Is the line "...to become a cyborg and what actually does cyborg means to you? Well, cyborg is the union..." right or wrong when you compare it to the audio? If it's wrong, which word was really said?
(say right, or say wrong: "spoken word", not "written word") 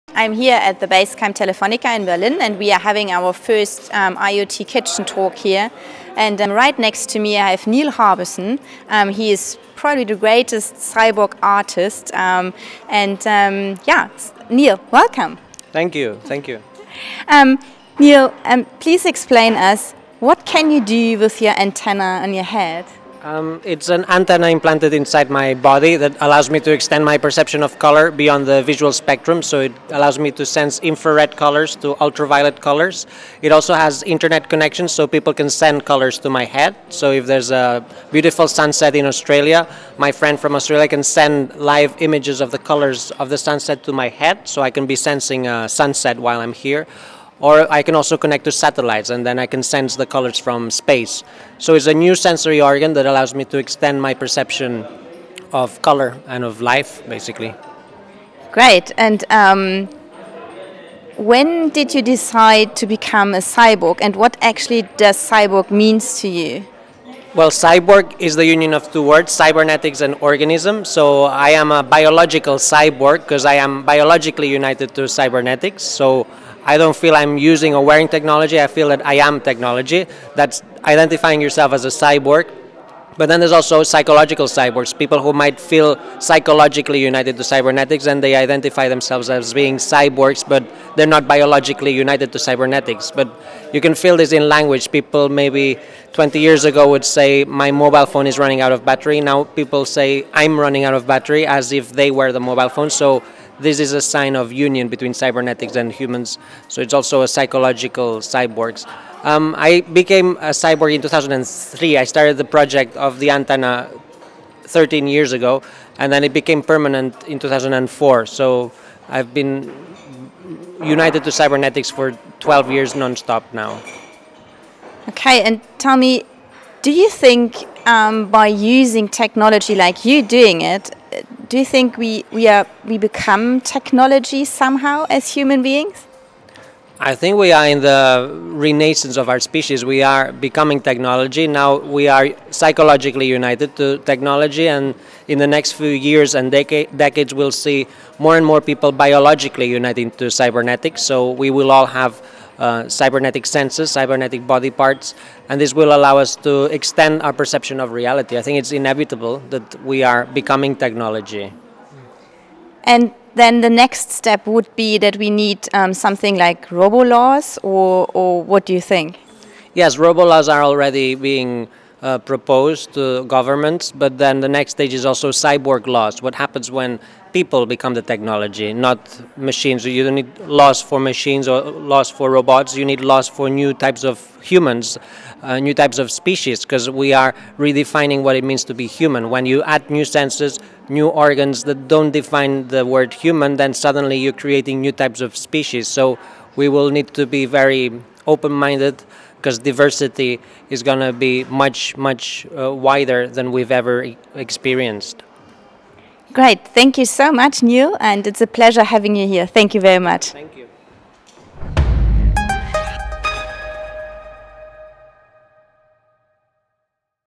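right.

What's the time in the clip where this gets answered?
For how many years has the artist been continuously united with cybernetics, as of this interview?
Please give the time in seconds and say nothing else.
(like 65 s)
122 s.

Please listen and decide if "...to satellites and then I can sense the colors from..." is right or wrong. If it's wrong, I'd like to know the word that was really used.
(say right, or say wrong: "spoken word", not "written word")
right.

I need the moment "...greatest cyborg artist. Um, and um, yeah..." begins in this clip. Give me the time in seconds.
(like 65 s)
10 s.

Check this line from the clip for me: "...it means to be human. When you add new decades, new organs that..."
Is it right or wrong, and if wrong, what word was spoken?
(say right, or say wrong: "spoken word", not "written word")
wrong: "senses", not "decades".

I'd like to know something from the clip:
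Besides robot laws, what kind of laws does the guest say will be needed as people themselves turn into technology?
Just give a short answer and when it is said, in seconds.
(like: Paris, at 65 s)
Cyborg laws, at 175 s.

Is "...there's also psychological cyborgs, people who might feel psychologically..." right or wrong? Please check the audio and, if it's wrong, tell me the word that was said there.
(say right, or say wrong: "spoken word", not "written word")
right.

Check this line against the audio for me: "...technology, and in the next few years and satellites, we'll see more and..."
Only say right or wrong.
wrong.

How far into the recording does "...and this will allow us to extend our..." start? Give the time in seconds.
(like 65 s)
155 s.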